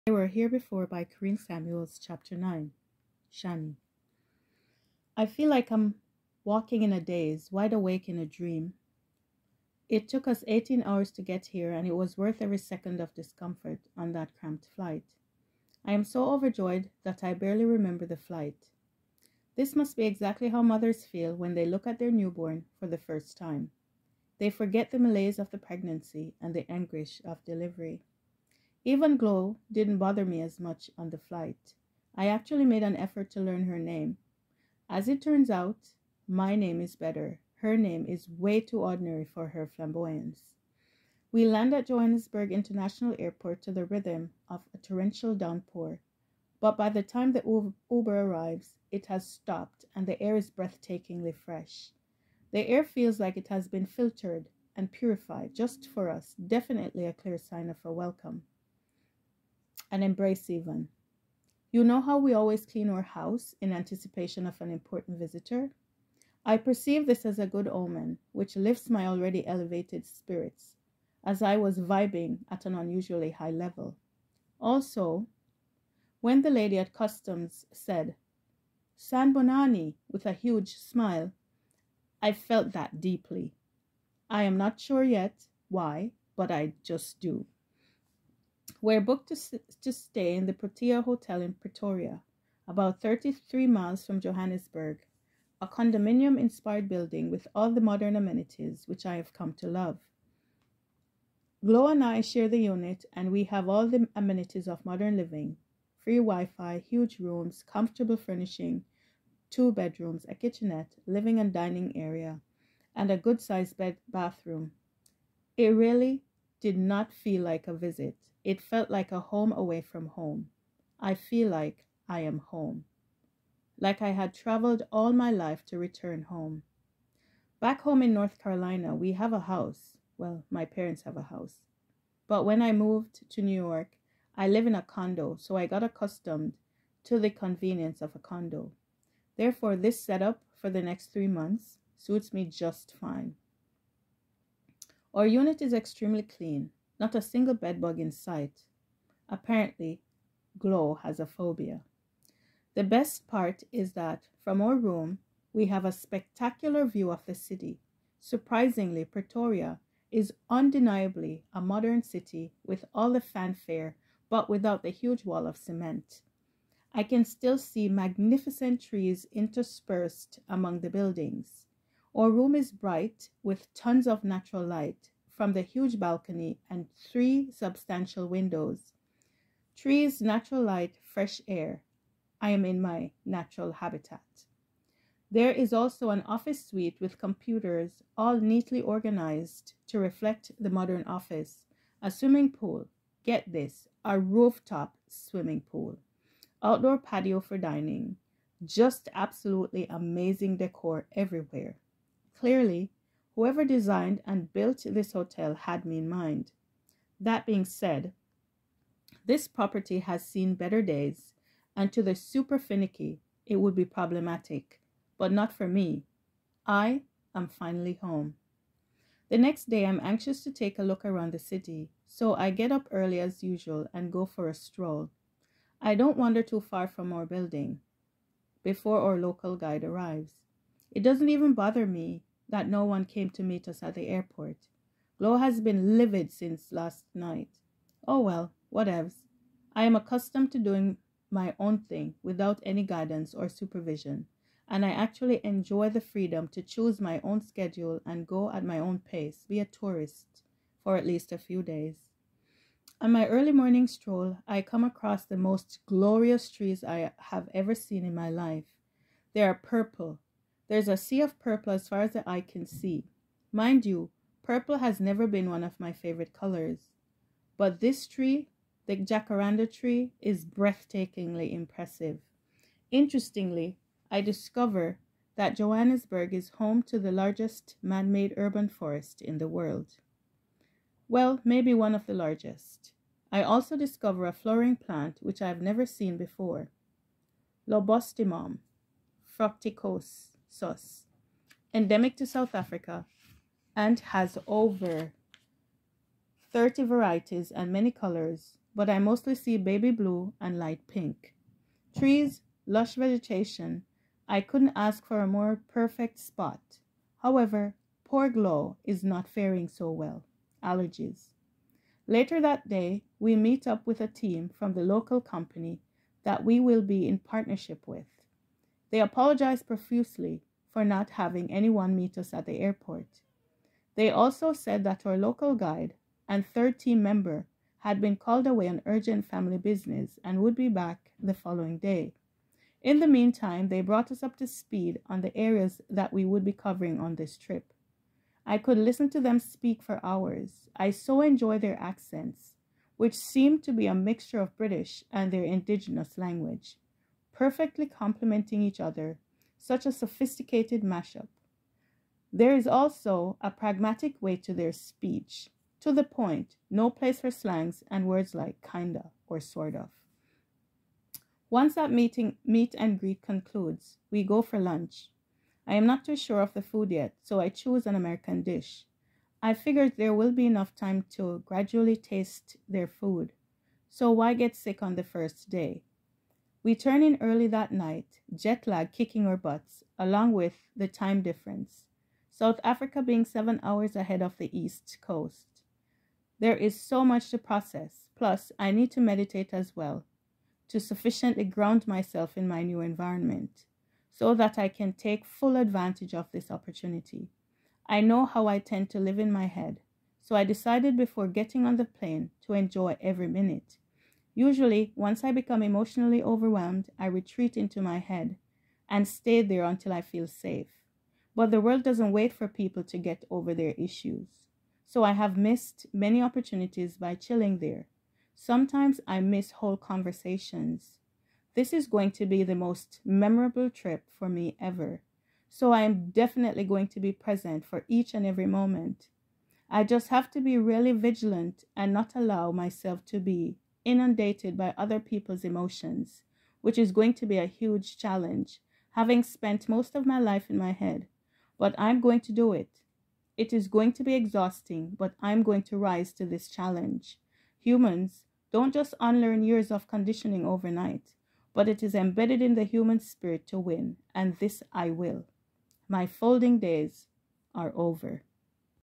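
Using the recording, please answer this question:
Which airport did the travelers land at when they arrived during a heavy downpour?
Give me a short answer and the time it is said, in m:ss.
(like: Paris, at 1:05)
Johannesburg International Airport, at 0:41.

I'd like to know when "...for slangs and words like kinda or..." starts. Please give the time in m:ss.
5:57.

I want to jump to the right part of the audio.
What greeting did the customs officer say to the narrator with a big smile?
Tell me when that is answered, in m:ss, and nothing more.
1:18.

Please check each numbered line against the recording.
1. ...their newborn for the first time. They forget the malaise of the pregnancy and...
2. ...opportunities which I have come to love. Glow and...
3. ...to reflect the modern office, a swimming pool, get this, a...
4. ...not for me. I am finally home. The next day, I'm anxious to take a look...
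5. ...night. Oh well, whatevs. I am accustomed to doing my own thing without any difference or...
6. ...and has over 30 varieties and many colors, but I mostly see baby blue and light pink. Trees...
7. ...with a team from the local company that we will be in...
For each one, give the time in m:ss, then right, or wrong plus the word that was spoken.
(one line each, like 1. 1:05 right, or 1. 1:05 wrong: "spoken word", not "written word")
1. 0:21 right
2. 1:38 wrong: "amenities", not "opportunities"
3. 3:09 right
4. 3:35 right
5. 3:57 wrong: "guidance", not "difference"
6. 4:53 right
7. 5:13 right.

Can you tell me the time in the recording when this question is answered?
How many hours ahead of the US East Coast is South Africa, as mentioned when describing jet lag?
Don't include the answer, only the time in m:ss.
6:23.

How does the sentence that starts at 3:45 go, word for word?
I don't wander too far from our building before our local guide arrives.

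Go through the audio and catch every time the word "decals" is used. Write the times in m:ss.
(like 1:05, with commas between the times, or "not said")
not said.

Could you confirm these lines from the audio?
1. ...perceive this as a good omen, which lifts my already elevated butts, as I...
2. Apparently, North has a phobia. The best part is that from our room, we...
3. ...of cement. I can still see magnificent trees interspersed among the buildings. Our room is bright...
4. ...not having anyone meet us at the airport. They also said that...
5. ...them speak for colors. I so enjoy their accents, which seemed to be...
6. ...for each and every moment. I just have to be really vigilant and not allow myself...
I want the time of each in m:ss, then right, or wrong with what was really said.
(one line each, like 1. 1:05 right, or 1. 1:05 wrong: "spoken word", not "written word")
1. 1:06 wrong: "spirits", not "butts"
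2. 2:29 wrong: "Glow", not "North"
3. 2:45 right
4. 5:20 right
5. 5:39 wrong: "hours", not "colors"
6. 7:07 right.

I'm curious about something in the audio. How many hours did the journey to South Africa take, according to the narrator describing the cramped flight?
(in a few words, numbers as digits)
18 hours.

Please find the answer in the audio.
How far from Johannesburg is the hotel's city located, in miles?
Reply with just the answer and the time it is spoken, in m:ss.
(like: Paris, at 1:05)
33 miles, at 1:33.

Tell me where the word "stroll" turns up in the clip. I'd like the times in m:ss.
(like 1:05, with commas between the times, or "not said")
3:44, 4:13.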